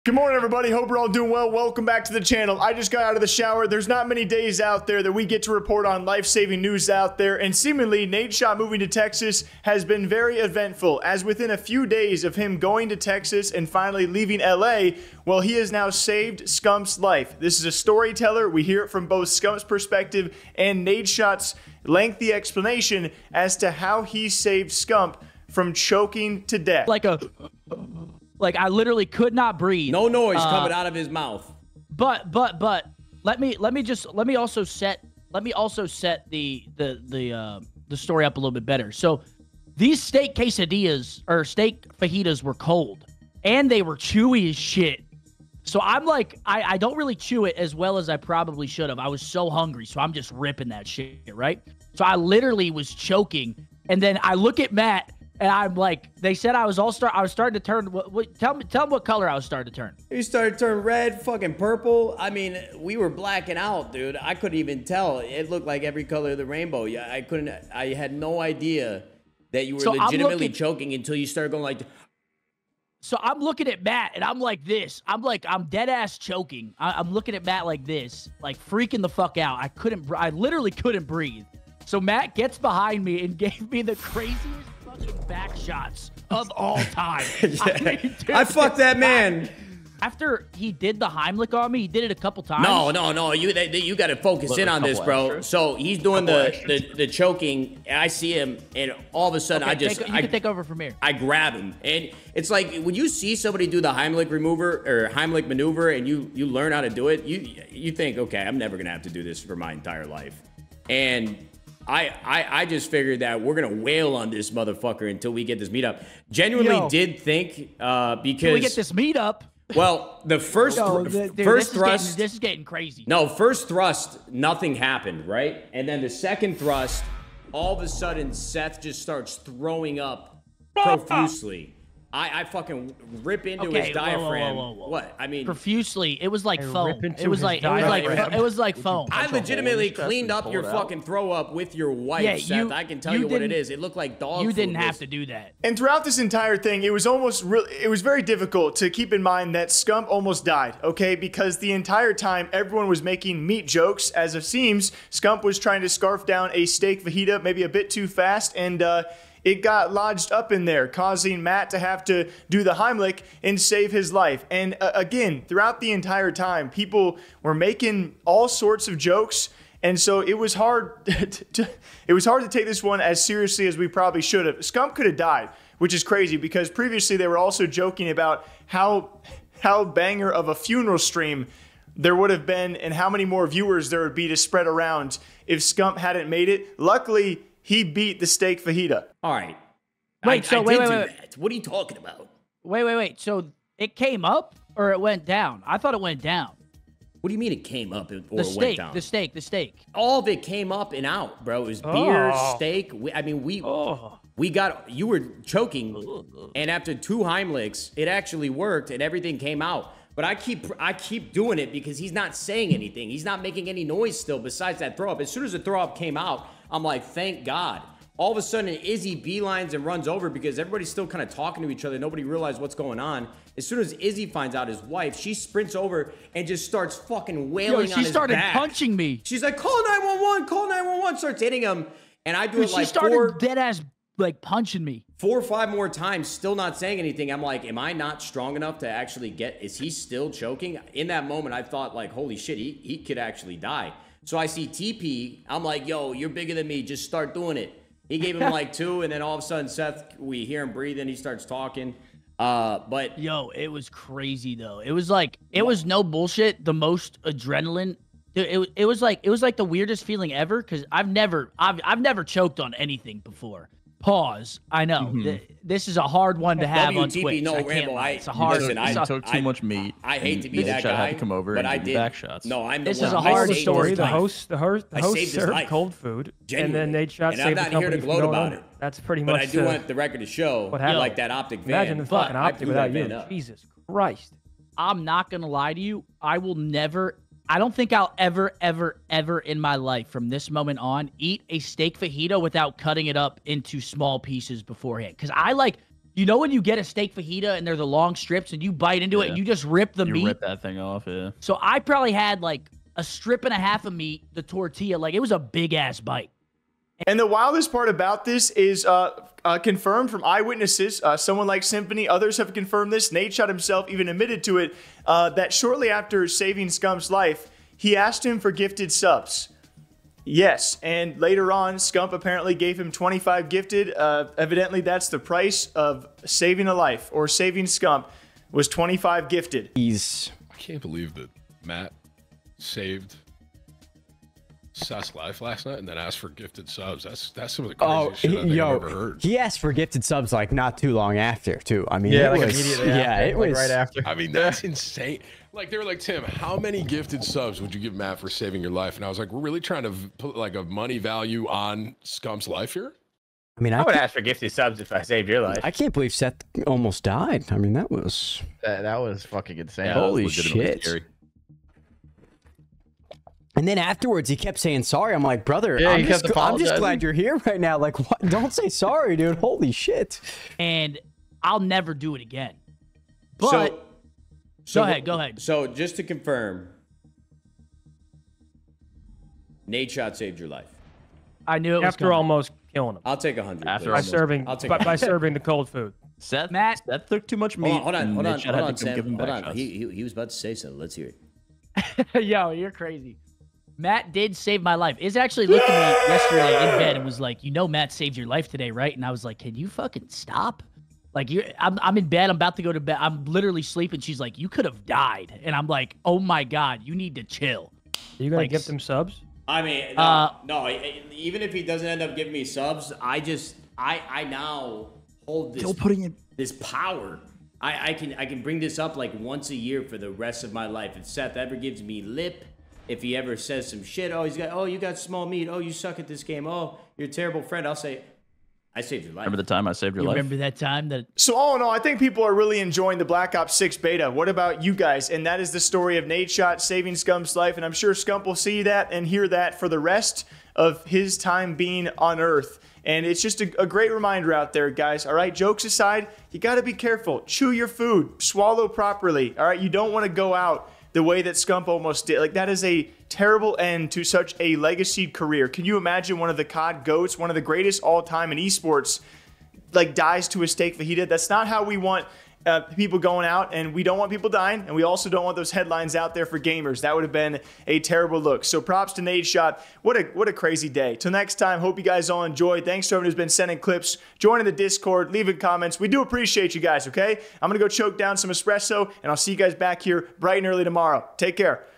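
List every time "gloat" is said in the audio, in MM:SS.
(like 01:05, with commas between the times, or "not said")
04:37.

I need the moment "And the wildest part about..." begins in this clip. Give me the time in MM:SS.
05:07.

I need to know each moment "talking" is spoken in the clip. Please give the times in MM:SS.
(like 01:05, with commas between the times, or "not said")
03:11, 03:41, 04:11.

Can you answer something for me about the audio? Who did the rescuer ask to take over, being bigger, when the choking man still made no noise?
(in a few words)
TP.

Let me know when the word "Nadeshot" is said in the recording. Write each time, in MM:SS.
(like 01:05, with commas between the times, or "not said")
00:08, 00:20, 04:37, 05:13, 06:19, 07:16, 07:49.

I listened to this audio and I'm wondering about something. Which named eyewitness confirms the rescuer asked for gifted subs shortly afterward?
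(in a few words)
Symphony.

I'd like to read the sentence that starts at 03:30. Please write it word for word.
But I keep I keep doing it because he's not saying anything.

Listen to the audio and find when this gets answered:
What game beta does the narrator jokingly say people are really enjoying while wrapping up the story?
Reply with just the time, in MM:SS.
07:13.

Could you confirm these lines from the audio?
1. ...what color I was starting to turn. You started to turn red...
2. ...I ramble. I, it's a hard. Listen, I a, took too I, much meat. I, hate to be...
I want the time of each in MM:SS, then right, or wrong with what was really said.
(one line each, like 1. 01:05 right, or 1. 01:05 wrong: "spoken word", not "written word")
1. 00:58 right
2. 04:27 right.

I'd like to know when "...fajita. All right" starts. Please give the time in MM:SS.
03:08.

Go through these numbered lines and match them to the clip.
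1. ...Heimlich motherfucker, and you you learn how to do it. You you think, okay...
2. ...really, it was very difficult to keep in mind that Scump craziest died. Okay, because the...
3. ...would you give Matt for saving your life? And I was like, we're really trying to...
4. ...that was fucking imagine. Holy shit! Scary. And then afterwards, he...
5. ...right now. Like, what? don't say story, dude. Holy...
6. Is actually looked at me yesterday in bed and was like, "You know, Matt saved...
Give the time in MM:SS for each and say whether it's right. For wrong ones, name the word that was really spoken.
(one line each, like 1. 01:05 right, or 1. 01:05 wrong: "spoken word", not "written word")
1. 01:45 wrong: "maneuver", not "motherfucker"
2. 02:27 wrong: "almost", not "craziest"
3. 05:47 right
4. 05:58 wrong: "insane", not "imagine"
5. 06:07 wrong: "sorry", not "story"
6. 06:34 right.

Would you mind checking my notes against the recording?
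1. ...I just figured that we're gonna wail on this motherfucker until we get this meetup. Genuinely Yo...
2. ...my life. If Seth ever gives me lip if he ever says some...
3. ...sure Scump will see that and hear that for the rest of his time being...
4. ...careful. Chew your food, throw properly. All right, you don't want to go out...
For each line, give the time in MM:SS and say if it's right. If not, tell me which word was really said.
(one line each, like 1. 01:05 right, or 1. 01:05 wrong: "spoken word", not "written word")
1. 01:52 right
2. 07:00 right
3. 07:17 right
4. 07:26 wrong: "swallow", not "throw".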